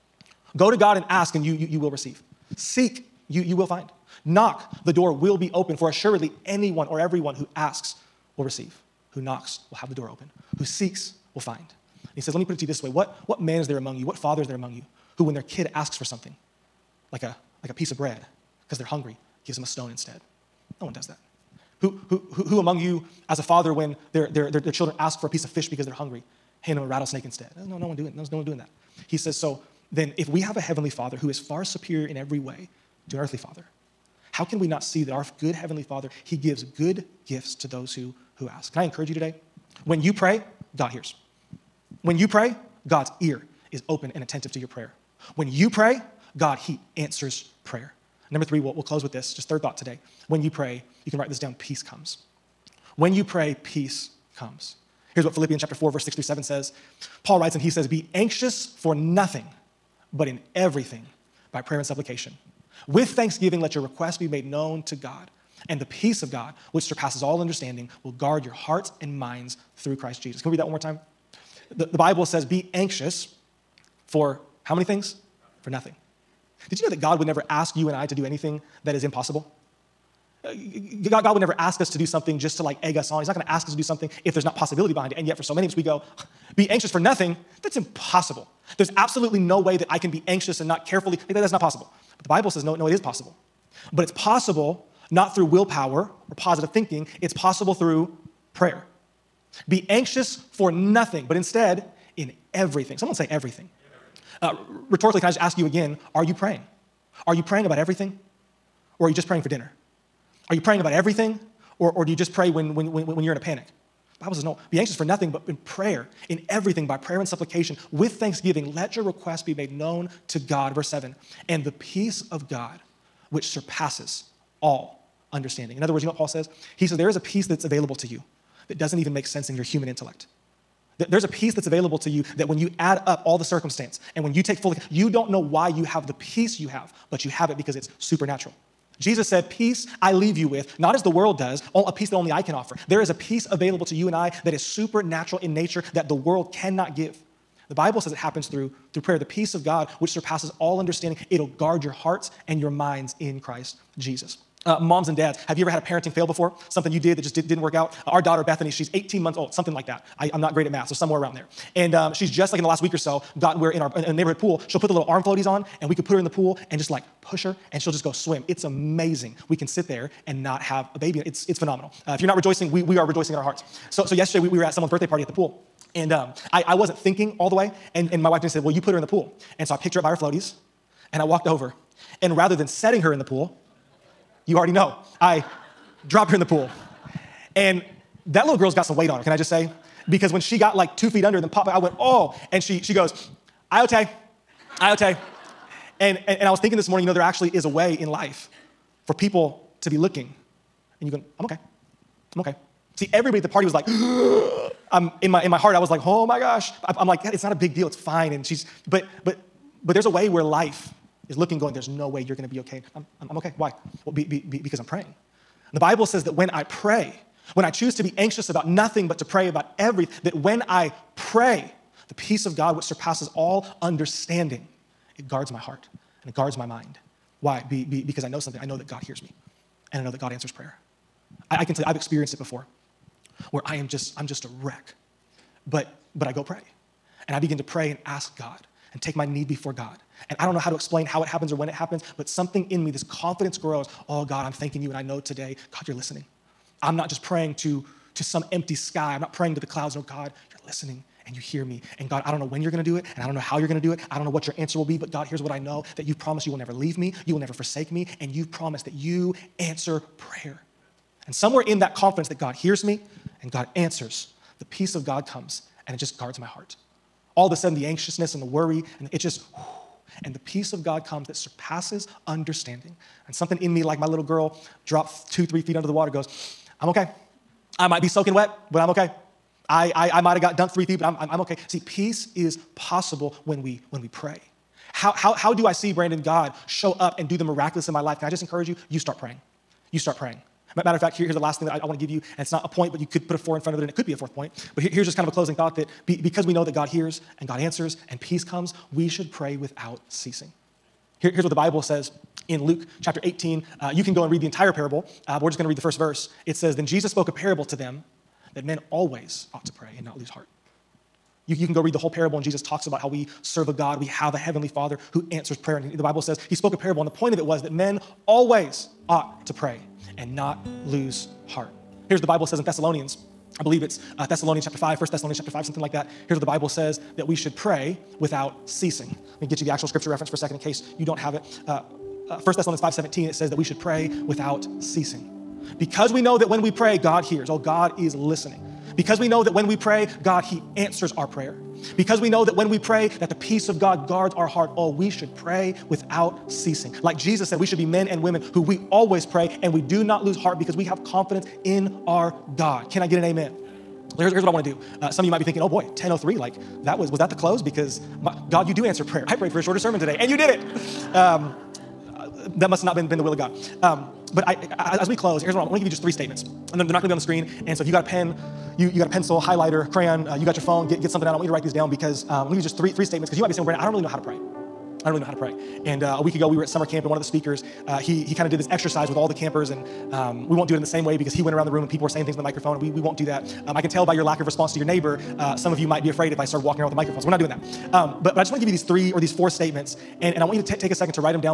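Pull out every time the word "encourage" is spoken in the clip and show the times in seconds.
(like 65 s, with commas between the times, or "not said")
38 s, 288 s.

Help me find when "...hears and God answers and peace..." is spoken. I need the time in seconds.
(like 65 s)
296 s.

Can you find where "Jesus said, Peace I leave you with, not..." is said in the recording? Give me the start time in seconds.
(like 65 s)
138 s.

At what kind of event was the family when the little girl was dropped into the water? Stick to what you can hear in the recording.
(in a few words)
birthday party.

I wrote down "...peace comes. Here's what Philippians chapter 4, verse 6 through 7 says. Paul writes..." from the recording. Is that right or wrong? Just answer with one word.
right.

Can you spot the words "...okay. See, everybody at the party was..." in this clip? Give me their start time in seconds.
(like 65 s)
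202 s.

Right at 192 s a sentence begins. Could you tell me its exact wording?
And she, she goes, Iote, Iote.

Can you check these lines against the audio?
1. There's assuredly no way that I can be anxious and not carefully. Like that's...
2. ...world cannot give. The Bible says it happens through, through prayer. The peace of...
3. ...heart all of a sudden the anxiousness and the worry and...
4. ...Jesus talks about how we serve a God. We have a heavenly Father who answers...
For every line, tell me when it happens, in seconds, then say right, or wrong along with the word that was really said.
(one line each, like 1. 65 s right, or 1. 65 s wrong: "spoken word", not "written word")
1. 88 s wrong: "absolutely", not "assuredly"
2. 146 s right
3. 266 s right
4. 312 s right.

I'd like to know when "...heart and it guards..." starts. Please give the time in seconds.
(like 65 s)
225 s.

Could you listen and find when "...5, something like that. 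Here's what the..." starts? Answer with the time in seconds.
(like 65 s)
325 s.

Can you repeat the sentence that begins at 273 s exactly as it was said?
And something in me, like my little girl, dropped two, three feet under the water, goes, I'm okay.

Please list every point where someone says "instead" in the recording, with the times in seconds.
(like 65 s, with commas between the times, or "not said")
19 s, 27 s, 101 s.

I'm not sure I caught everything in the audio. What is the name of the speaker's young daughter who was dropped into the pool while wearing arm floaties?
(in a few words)
Bethany.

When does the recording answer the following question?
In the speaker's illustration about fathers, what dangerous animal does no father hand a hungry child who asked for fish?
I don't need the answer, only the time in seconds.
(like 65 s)
26 s.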